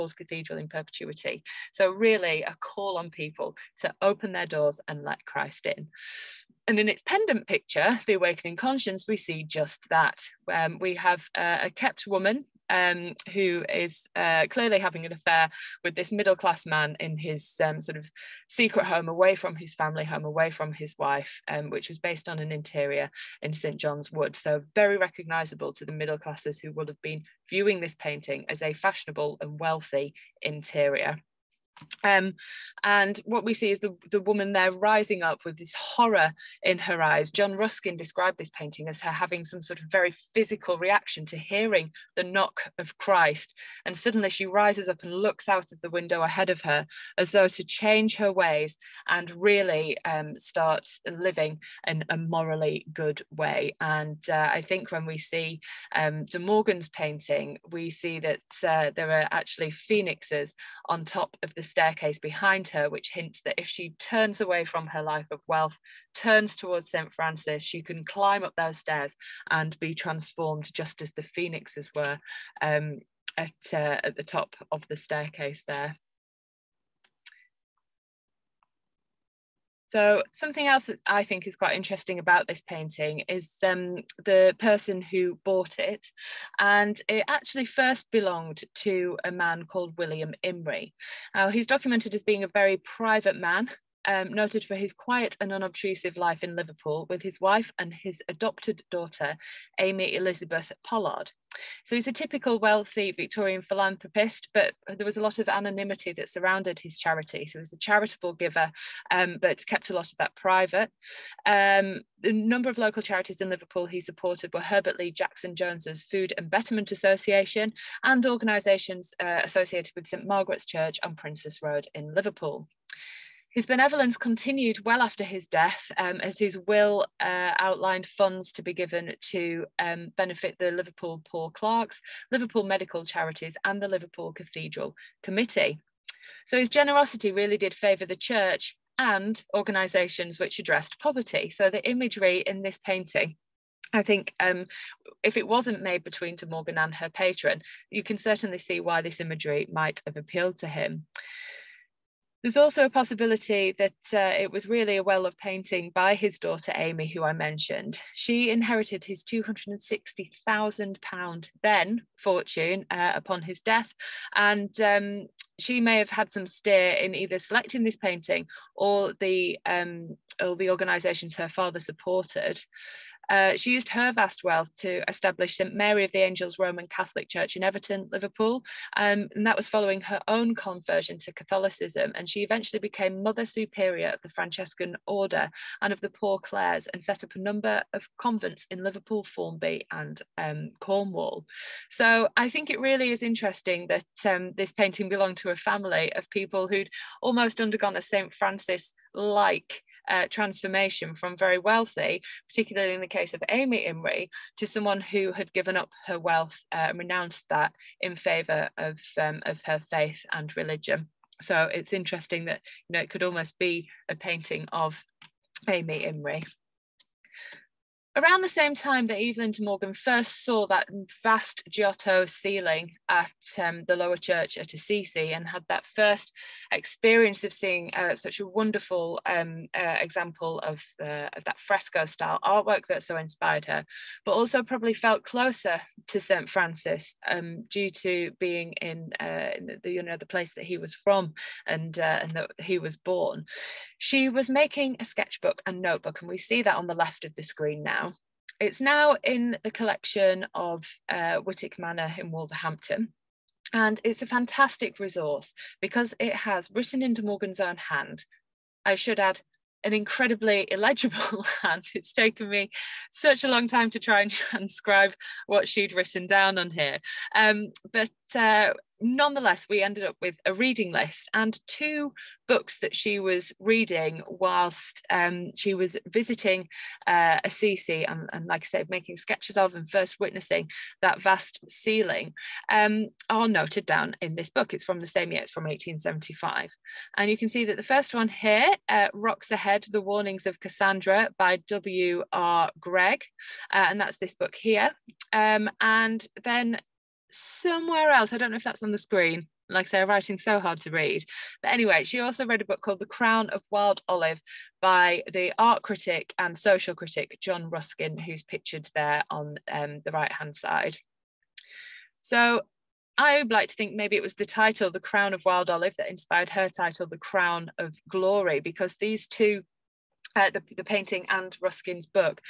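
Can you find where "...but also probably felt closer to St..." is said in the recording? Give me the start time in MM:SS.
03:54.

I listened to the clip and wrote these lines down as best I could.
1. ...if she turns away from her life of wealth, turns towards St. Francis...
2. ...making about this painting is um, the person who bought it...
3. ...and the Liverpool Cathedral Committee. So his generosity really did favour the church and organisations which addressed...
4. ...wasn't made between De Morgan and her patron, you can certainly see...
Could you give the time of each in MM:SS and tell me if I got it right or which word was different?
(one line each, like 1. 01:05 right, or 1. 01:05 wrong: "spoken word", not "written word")
1. 01:03 right
2. 01:21 wrong: "interesting", not "making"
3. 02:13 right
4. 02:25 right.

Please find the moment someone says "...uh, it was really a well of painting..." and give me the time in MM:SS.
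02:34.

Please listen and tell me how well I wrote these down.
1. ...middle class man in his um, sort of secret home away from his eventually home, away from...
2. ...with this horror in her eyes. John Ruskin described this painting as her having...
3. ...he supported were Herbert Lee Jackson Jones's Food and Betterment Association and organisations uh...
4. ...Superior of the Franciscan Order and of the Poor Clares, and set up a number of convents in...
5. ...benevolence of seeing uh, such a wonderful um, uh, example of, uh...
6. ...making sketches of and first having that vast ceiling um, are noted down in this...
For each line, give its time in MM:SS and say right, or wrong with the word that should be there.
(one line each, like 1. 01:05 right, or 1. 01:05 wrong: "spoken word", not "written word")
1. 00:16 wrong: "family", not "eventually"
2. 00:35 right
3. 01:53 right
4. 03:03 right
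5. 03:46 wrong: "experience", not "benevolence"
6. 04:38 wrong: "witnessing", not "having".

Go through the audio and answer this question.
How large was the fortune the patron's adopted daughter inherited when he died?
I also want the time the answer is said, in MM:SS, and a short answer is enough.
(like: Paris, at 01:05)
£260,000, at 02:39.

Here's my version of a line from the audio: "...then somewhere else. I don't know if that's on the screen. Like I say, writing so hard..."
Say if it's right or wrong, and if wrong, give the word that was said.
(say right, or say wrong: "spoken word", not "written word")
right.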